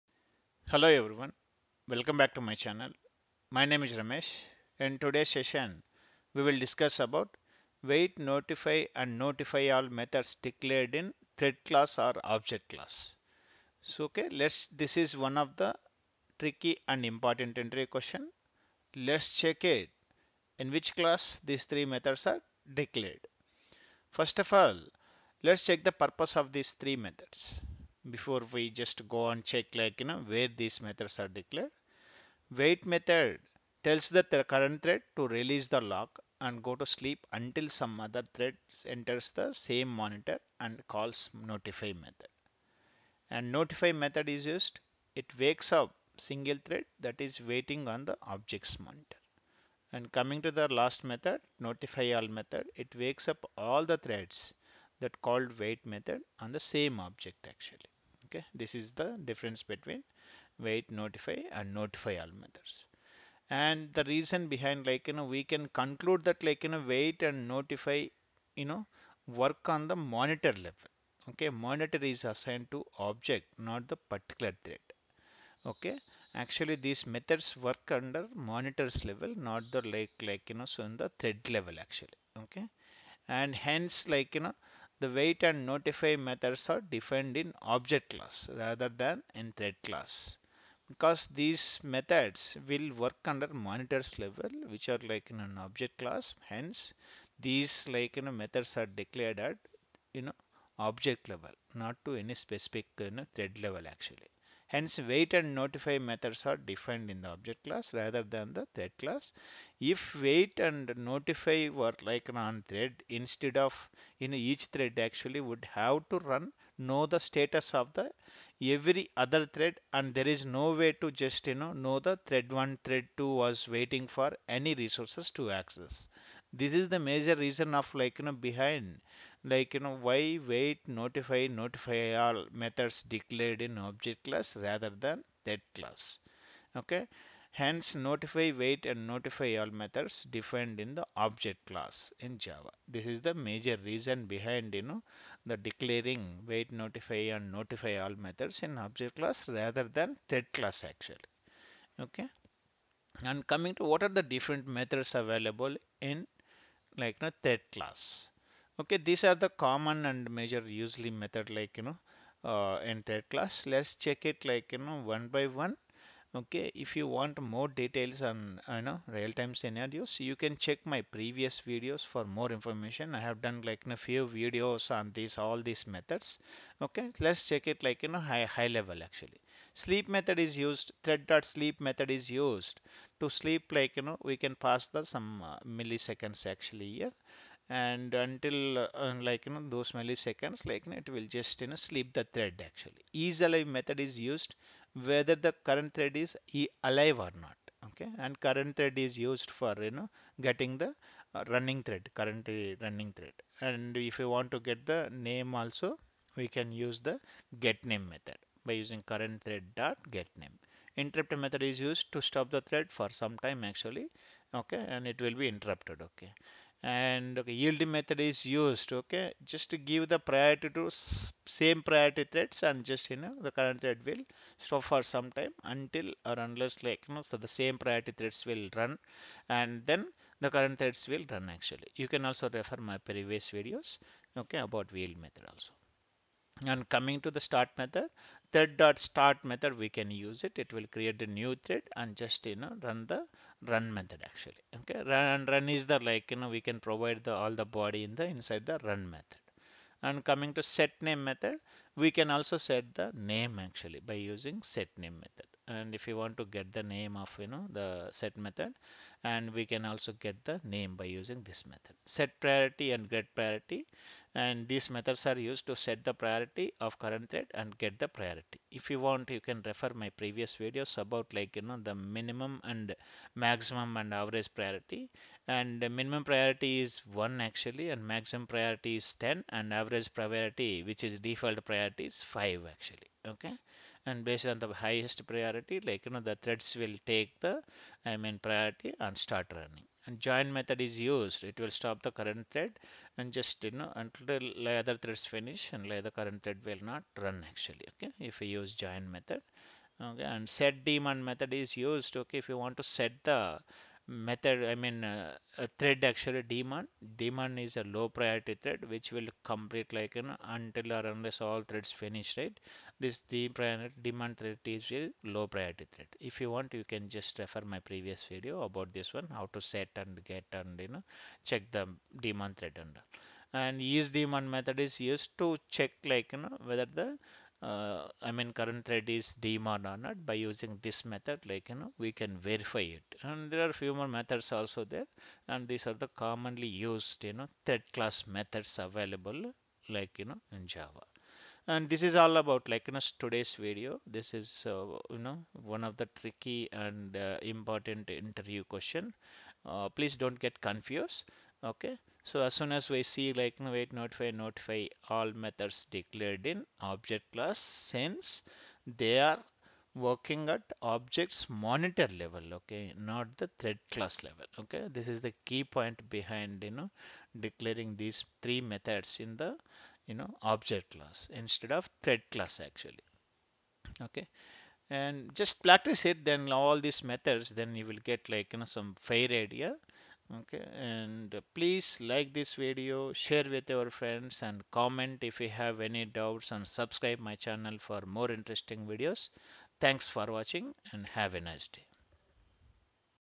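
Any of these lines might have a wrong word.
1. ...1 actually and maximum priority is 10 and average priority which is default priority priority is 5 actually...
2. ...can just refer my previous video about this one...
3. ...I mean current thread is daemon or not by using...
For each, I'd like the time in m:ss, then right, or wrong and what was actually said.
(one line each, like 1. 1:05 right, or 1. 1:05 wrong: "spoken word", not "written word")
1. 4:37 right
2. 5:16 right
3. 5:28 right.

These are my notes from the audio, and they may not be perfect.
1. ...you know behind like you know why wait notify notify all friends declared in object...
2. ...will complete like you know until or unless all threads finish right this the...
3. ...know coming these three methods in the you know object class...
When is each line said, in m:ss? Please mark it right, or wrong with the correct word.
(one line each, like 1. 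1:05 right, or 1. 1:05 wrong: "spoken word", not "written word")
1. 2:08 wrong: "methods", not "friends"
2. 5:09 right
3. 6:06 wrong: "declaring", not "coming".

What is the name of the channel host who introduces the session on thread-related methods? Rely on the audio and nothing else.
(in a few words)
Ramesh.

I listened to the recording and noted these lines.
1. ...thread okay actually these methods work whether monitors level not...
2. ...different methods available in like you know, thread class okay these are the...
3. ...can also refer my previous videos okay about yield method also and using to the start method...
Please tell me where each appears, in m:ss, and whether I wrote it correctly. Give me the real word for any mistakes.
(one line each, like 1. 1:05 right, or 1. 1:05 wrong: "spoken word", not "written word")
1. 1:14 wrong: "under", not "whether"
2. 2:34 right
3. 3:52 wrong: "coming", not "using".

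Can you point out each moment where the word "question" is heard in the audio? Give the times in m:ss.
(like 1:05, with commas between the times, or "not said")
0:17, 5:48.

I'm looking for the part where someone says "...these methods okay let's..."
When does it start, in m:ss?
2:55.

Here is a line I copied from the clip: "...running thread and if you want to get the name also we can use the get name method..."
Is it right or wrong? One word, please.
right.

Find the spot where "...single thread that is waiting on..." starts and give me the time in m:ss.
0:46.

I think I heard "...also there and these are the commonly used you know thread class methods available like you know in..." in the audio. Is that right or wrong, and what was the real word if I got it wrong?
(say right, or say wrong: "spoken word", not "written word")
right.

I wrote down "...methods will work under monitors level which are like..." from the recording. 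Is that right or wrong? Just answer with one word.
right.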